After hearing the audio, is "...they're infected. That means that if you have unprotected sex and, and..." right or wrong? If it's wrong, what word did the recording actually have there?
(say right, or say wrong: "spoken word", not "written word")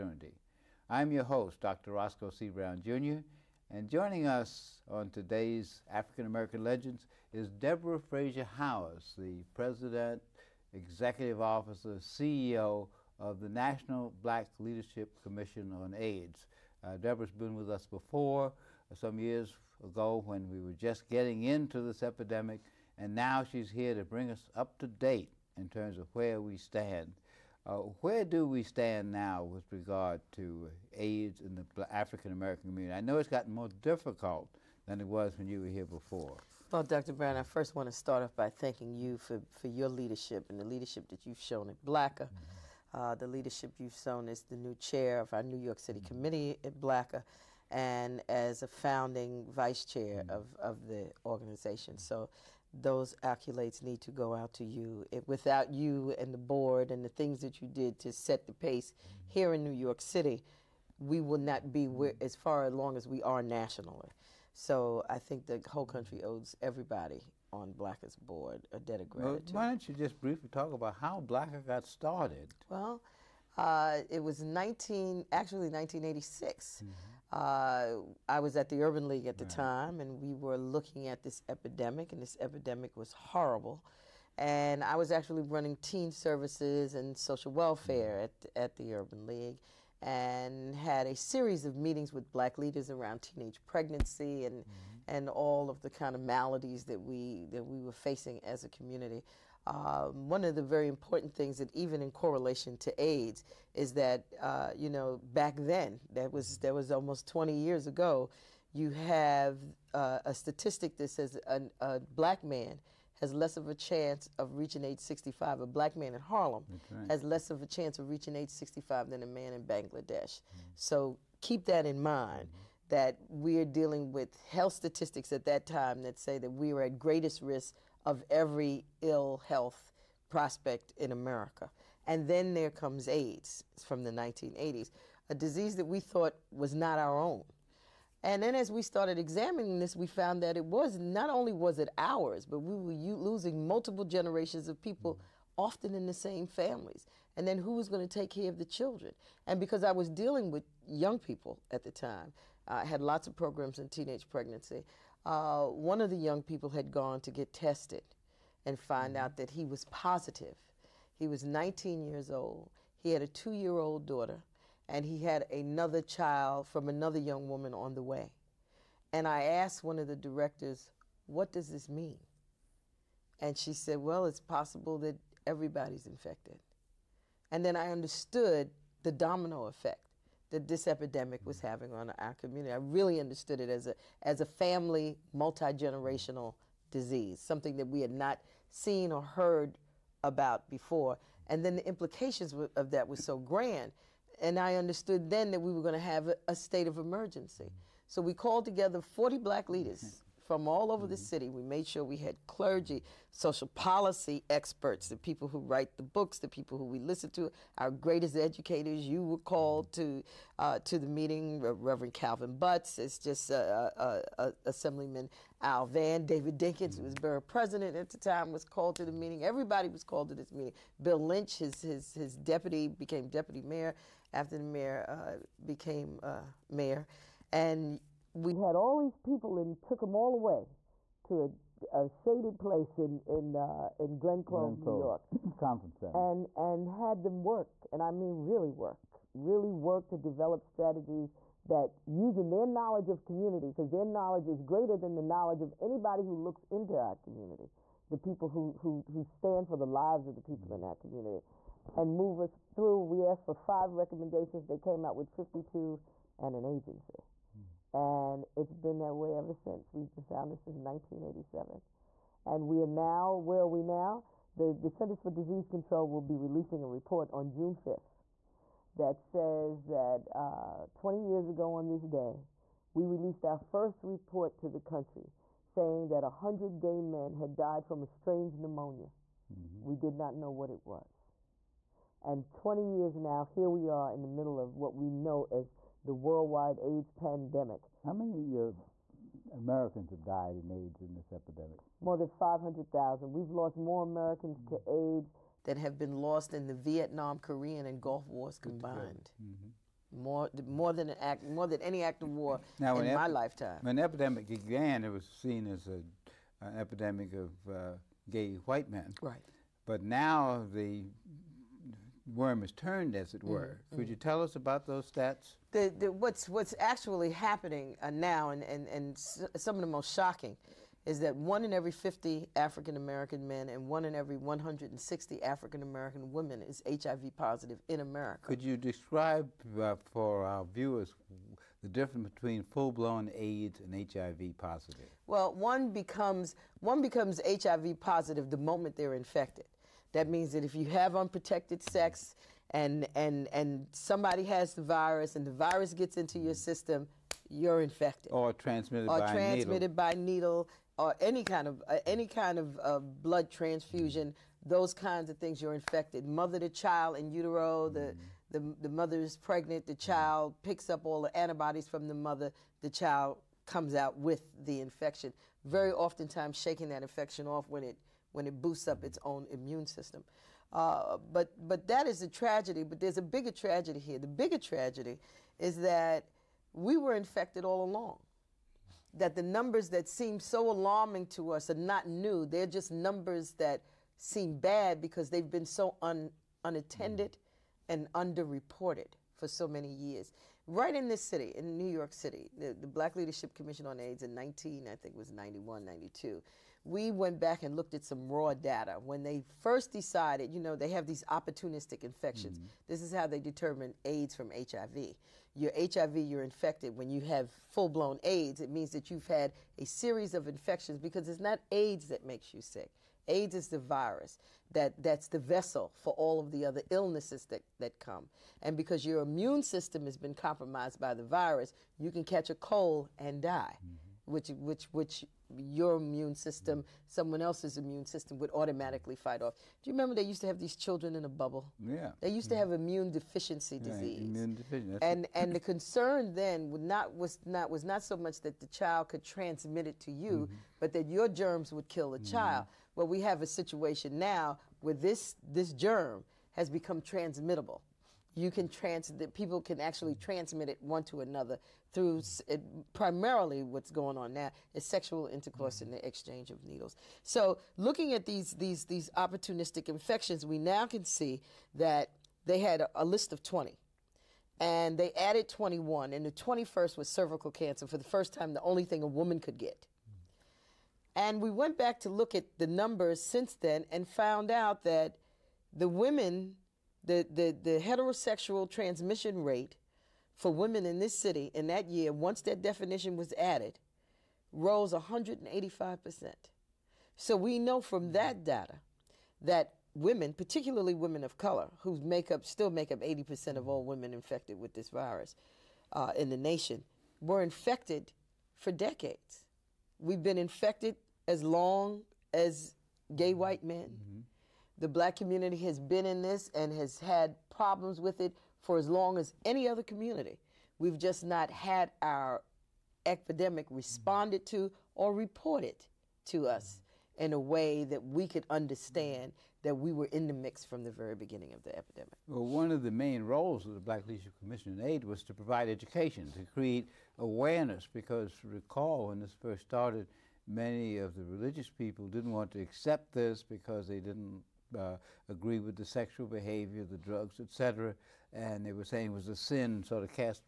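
right.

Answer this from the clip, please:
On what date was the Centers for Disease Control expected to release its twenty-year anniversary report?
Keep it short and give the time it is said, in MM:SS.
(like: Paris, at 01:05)
June 5th, at 04:27.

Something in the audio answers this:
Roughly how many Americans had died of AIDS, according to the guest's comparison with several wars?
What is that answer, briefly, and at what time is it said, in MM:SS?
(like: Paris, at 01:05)
More than 500,000, at 04:52.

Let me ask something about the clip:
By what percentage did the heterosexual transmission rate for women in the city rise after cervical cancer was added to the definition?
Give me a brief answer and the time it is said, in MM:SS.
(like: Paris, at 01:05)
185%, at 08:04.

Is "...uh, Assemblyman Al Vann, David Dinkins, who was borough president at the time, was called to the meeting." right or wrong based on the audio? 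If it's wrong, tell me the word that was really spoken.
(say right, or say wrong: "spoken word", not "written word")
right.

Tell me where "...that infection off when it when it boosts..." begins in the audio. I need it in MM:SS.
06:06.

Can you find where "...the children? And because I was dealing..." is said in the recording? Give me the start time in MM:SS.
02:28.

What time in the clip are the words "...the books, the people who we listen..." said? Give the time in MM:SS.
03:25.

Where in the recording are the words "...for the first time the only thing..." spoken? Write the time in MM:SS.
07:47.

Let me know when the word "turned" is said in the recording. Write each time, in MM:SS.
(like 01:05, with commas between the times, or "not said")
05:12.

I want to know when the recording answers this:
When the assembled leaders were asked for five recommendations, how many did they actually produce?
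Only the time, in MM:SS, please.
04:15.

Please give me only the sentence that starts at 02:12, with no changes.
And then there comes AIDS from the 1980s, a disease that we thought was not our own.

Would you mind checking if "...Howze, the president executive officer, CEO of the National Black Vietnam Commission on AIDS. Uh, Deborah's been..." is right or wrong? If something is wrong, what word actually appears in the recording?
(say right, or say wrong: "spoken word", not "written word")
wrong: "Leadership", not "Vietnam".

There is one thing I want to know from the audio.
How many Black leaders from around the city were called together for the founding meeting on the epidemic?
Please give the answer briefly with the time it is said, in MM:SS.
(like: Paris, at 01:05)
40, at 03:19.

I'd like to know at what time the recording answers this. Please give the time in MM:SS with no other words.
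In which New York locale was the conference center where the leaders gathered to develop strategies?
03:54.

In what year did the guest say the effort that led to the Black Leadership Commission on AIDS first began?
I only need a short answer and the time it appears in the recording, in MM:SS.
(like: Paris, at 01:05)
1986, at 01:15.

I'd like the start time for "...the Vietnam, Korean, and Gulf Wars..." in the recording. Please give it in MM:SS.
04:56.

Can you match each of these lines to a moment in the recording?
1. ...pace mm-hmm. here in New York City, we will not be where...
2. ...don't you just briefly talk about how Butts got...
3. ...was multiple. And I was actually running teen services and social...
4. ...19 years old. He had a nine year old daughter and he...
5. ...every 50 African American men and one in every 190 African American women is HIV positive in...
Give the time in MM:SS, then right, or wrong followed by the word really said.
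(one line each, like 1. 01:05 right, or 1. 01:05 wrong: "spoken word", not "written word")
1. 00:58 right
2. 01:09 wrong: "BLCA", not "Butts"
3. 01:22 wrong: "horrible", not "multiple"
4. 02:41 wrong: "two", not "nine"
5. 05:21 wrong: "160", not "190".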